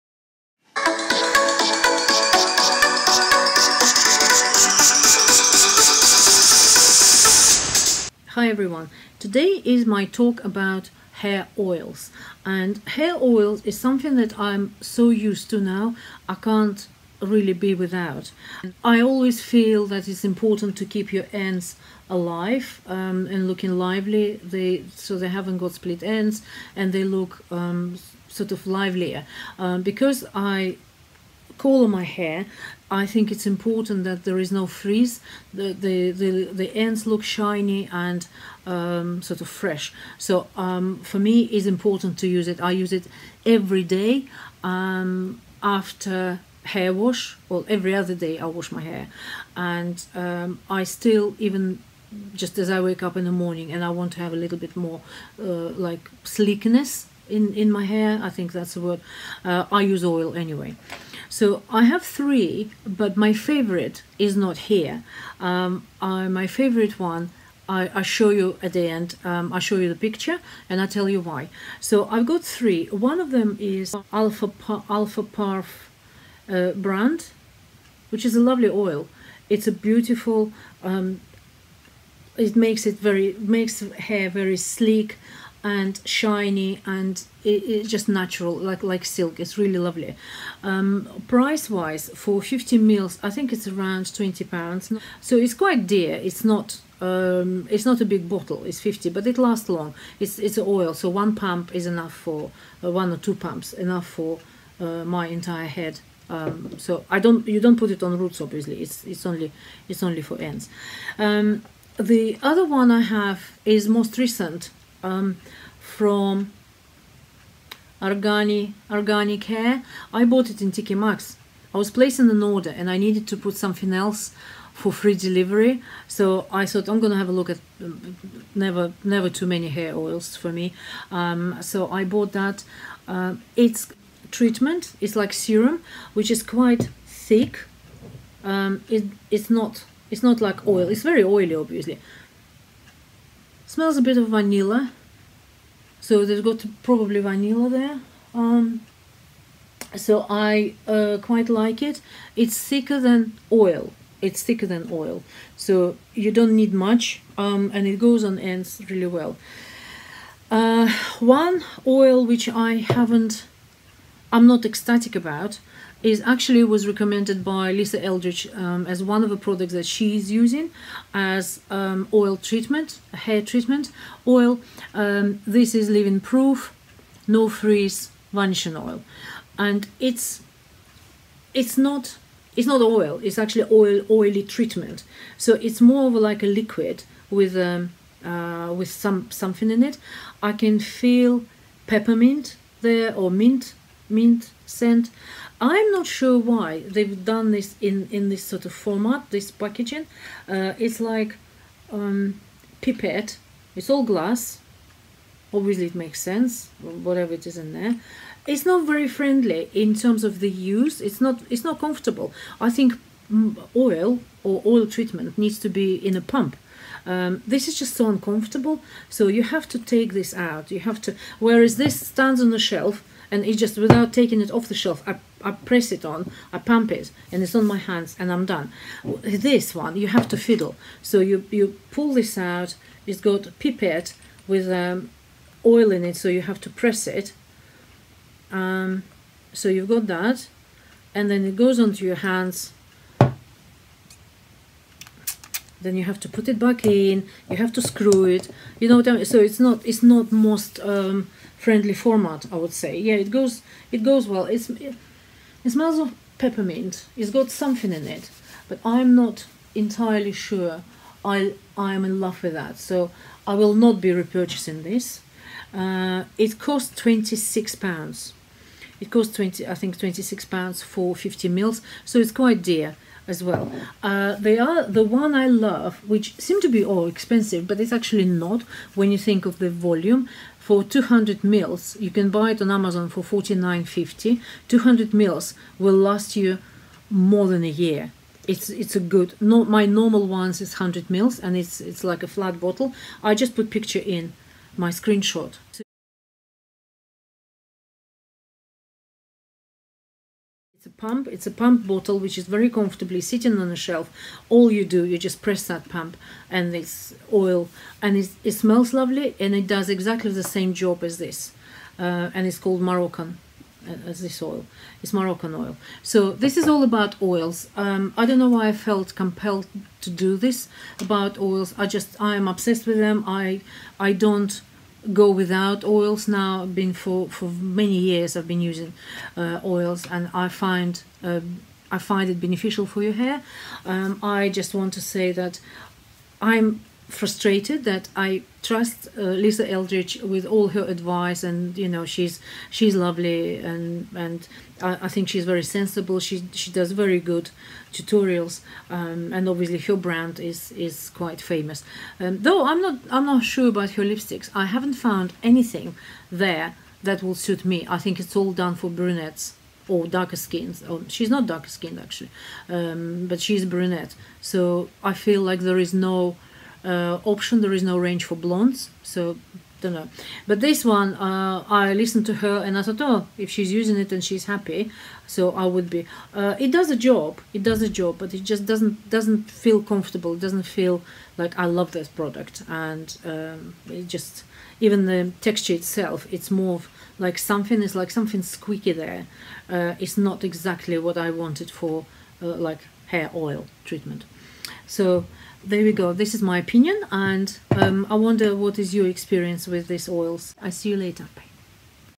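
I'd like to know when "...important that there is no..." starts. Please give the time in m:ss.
0:33.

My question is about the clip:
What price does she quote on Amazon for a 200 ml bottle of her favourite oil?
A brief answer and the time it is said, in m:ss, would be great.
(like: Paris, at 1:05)
49.50, at 4:43.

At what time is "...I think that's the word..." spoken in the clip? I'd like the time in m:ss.
0:58.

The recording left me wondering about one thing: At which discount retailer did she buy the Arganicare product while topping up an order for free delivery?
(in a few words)
TK Maxx.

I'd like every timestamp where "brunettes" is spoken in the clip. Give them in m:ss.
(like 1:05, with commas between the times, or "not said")
5:58, 6:03.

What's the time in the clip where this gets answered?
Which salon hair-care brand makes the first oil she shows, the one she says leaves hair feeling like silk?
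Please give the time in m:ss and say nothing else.
1:14.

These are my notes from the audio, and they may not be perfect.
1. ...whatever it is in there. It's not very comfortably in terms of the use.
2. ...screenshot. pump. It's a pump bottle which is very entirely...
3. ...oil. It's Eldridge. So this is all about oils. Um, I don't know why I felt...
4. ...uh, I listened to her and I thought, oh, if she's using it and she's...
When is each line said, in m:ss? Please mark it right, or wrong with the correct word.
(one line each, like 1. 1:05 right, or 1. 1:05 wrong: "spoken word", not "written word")
1. 3:26 wrong: "friendly", not "comfortably"
2. 4:54 wrong: "comfortably", not "entirely"
3. 5:14 wrong: "Moroccanoil", not "Eldridge"
4. 6:11 right.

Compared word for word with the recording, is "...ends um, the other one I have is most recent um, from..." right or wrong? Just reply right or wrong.
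right.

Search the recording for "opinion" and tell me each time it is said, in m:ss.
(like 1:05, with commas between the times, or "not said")
6:36.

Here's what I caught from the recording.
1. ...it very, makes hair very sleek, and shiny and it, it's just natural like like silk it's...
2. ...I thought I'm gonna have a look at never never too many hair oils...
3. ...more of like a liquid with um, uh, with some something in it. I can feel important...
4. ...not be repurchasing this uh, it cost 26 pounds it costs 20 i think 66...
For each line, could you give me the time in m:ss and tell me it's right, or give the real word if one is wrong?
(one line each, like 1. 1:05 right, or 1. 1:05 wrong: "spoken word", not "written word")
1. 1:22 right
2. 2:06 right
3. 3:05 wrong: "peppermint", not "important"
4. 4:23 wrong: "26", not "66".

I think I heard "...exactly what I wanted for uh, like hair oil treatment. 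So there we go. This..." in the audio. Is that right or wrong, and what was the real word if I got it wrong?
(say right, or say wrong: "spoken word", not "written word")
right.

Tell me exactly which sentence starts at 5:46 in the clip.
She she does very good tutorials, um, and obviously her brand is is quite famous.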